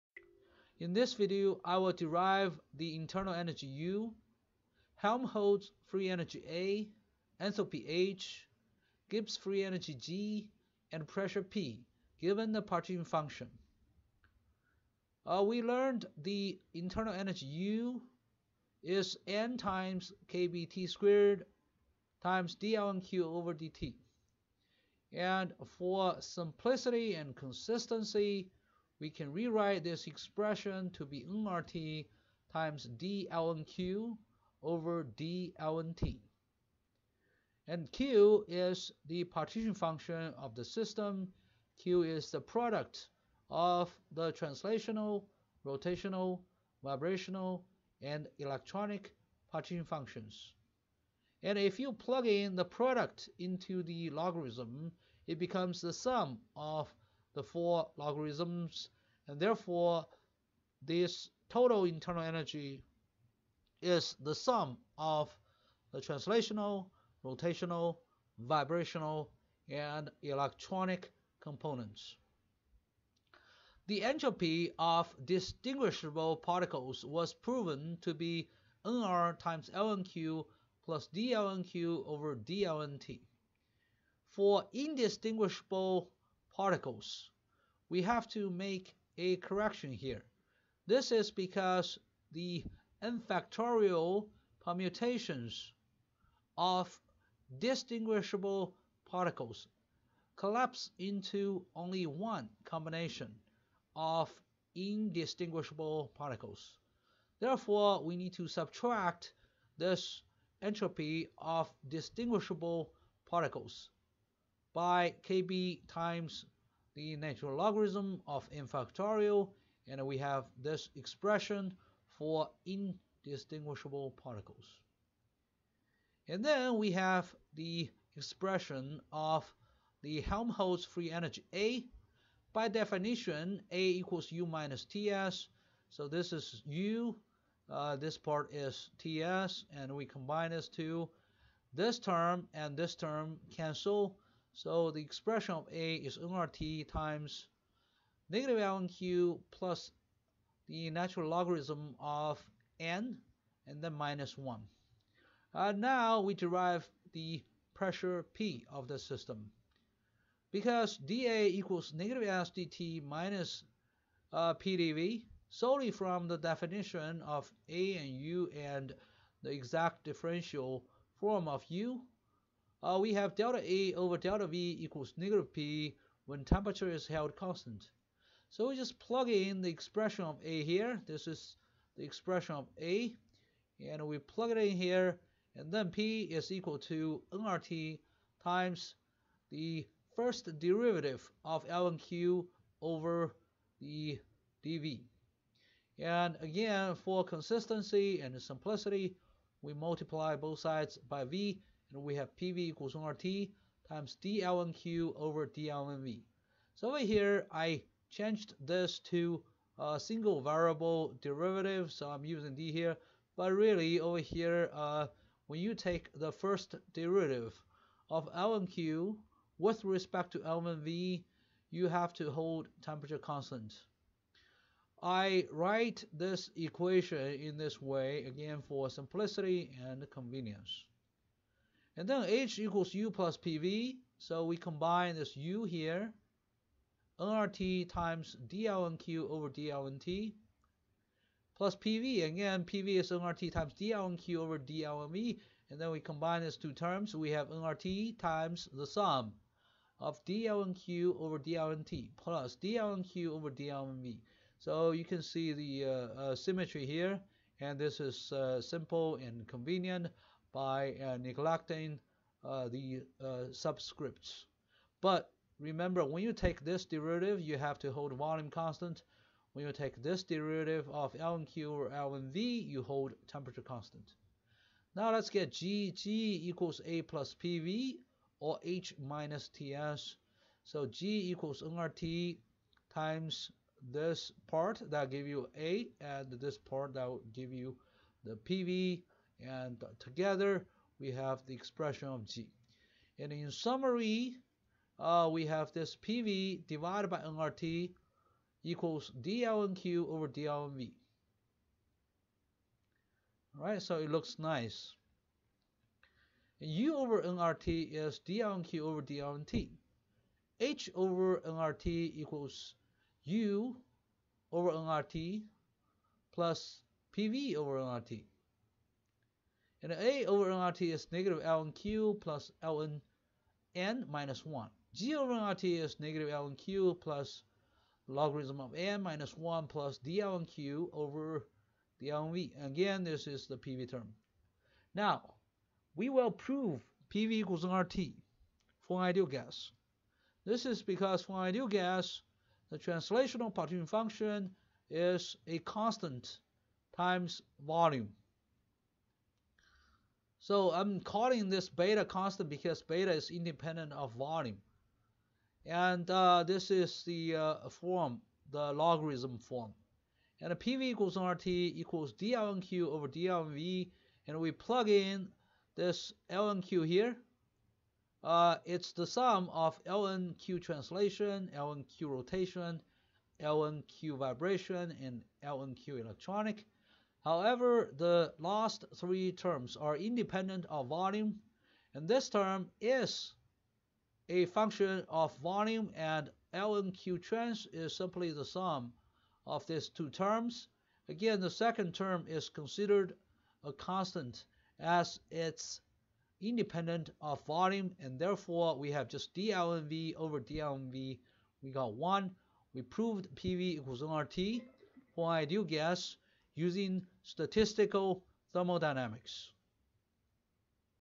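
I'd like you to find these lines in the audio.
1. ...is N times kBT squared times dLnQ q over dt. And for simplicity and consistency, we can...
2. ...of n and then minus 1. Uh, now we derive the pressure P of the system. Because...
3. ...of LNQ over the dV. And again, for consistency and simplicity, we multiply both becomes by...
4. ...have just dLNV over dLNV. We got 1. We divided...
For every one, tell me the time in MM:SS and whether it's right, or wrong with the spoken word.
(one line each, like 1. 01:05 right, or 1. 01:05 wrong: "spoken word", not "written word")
1. 00:18 right
2. 02:31 right
3. 03:11 wrong: "sides", not "becomes"
4. 06:38 wrong: "proved", not "divided".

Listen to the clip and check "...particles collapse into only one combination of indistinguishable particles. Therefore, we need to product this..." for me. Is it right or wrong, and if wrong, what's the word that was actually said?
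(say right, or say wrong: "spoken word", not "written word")
wrong: "subtract", not "product".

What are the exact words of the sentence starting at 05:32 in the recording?
Again, this is the PV term.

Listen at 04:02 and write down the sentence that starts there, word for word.
Again, PV is nRT times dLnQ over dLnV.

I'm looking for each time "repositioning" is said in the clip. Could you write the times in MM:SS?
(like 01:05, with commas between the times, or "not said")
not said.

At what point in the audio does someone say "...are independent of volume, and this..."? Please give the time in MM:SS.
06:19.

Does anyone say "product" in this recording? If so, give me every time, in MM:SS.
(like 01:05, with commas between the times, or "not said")
00:42, 00:52.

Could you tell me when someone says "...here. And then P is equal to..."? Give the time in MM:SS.
03:04.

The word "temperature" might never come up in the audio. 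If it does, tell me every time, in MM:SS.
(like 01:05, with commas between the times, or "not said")
02:56, 03:42, 04:33.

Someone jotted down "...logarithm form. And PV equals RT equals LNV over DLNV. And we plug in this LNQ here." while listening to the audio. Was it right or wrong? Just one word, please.
wrong.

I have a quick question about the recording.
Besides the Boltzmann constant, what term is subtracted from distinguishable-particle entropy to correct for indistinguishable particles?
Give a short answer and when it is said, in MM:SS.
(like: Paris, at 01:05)
natural logarithm of n factorial, at 01:57.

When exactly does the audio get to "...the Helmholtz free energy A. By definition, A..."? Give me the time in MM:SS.
02:10.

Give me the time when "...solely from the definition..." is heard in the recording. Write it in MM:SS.
02:45.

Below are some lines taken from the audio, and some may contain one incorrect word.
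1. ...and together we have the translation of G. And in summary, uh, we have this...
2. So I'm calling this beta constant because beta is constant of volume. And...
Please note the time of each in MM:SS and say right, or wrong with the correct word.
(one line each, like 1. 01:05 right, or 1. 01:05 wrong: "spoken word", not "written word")
1. 04:49 wrong: "expression", not "translation"
2. 05:50 wrong: "independent", not "constant".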